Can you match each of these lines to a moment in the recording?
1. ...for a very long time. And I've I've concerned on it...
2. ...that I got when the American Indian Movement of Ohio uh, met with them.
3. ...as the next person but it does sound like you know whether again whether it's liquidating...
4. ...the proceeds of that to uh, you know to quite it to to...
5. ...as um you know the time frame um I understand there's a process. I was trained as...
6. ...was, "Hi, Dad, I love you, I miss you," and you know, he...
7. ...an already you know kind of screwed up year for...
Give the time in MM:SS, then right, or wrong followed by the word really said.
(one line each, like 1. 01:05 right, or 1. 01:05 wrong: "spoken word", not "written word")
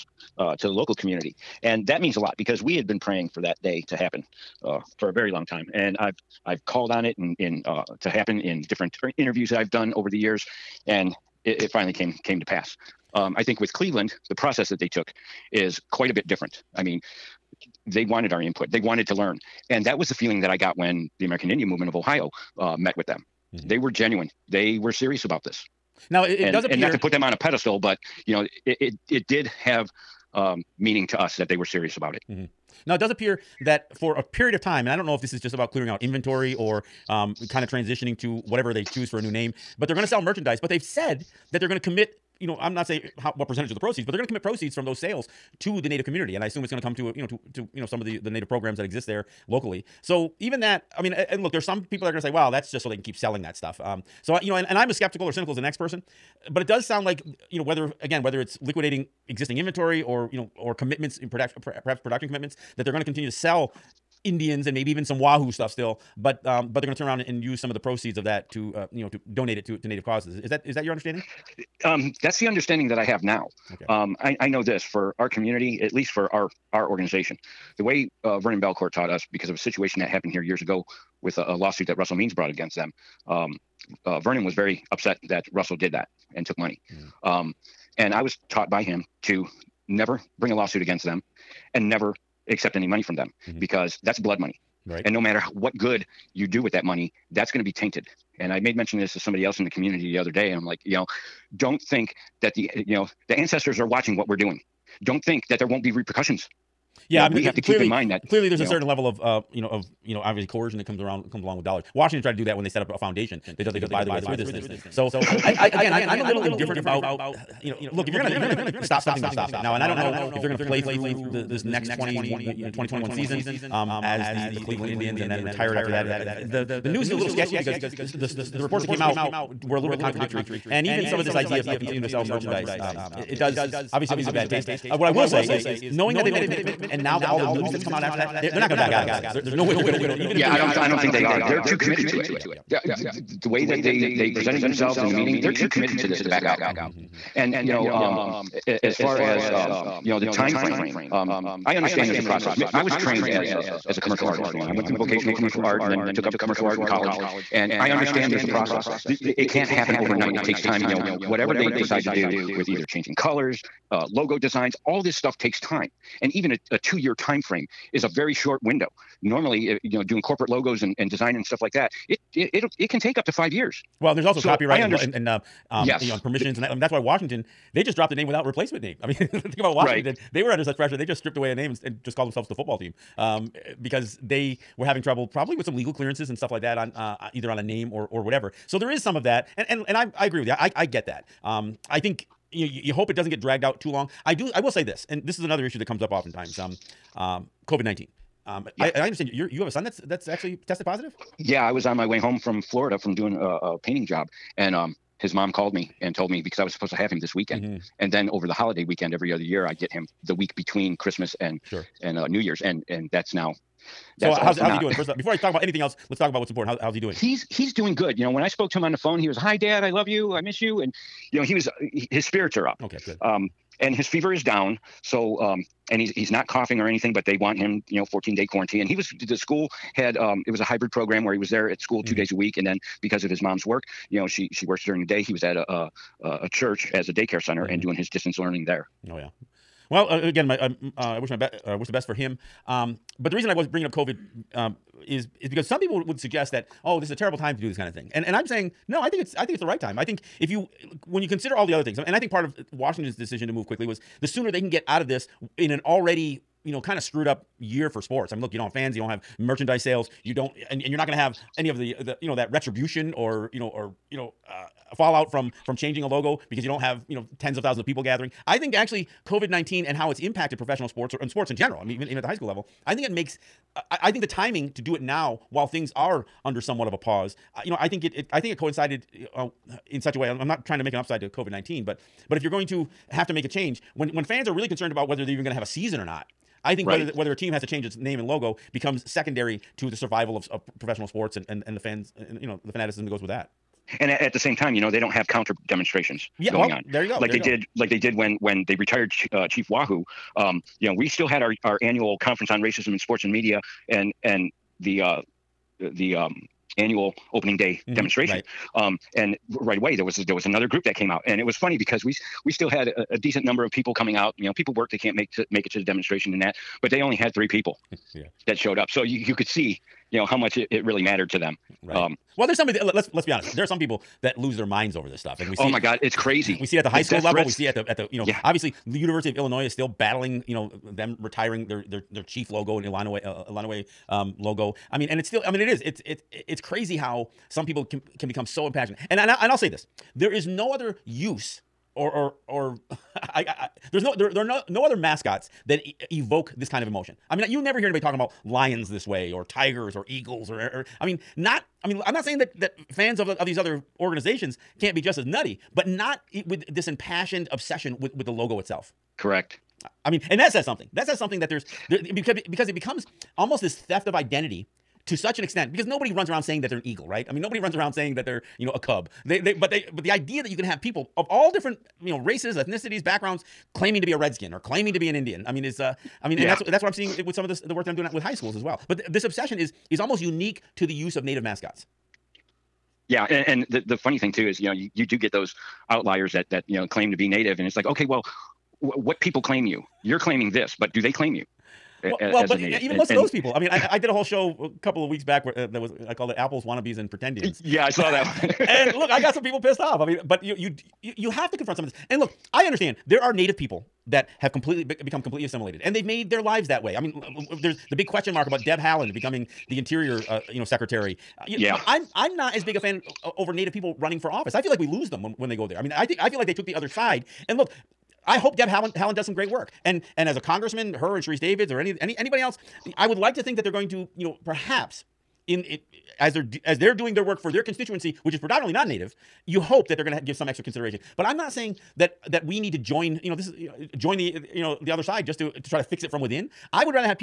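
1. 00:04 wrong: "called", not "concerned"
2. 00:20 right
3. 00:55 right
4. 01:07 wrong: "donate", not "quite"
5. 02:29 right
6. 03:39 right
7. 04:15 right.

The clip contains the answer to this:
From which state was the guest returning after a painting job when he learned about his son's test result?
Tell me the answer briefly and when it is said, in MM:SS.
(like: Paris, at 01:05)
Florida, at 03:22.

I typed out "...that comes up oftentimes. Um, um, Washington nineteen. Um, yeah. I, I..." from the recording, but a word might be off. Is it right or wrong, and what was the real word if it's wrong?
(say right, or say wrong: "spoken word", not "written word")
wrong: "COVID", not "Washington".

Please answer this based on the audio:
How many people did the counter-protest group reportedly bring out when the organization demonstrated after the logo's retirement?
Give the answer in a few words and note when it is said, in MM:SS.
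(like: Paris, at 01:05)
3, at 05:17.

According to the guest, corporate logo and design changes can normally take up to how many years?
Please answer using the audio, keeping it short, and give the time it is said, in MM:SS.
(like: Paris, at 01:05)
5, at 02:53.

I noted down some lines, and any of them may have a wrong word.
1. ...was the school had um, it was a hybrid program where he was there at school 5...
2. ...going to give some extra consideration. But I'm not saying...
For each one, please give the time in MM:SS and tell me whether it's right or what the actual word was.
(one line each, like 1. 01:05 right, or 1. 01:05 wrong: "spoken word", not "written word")
1. 03:48 wrong: "2", not "5"
2. 07:10 right.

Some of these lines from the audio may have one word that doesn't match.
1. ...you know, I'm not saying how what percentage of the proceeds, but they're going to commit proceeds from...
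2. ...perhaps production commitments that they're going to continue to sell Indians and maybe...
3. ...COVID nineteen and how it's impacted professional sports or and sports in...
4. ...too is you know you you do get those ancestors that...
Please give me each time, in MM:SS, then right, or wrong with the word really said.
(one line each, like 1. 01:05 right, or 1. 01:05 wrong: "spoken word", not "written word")
1. 00:42 right
2. 01:01 right
3. 04:29 right
4. 06:24 wrong: "outliers", not "ancestors".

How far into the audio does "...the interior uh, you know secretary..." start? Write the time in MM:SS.
06:49.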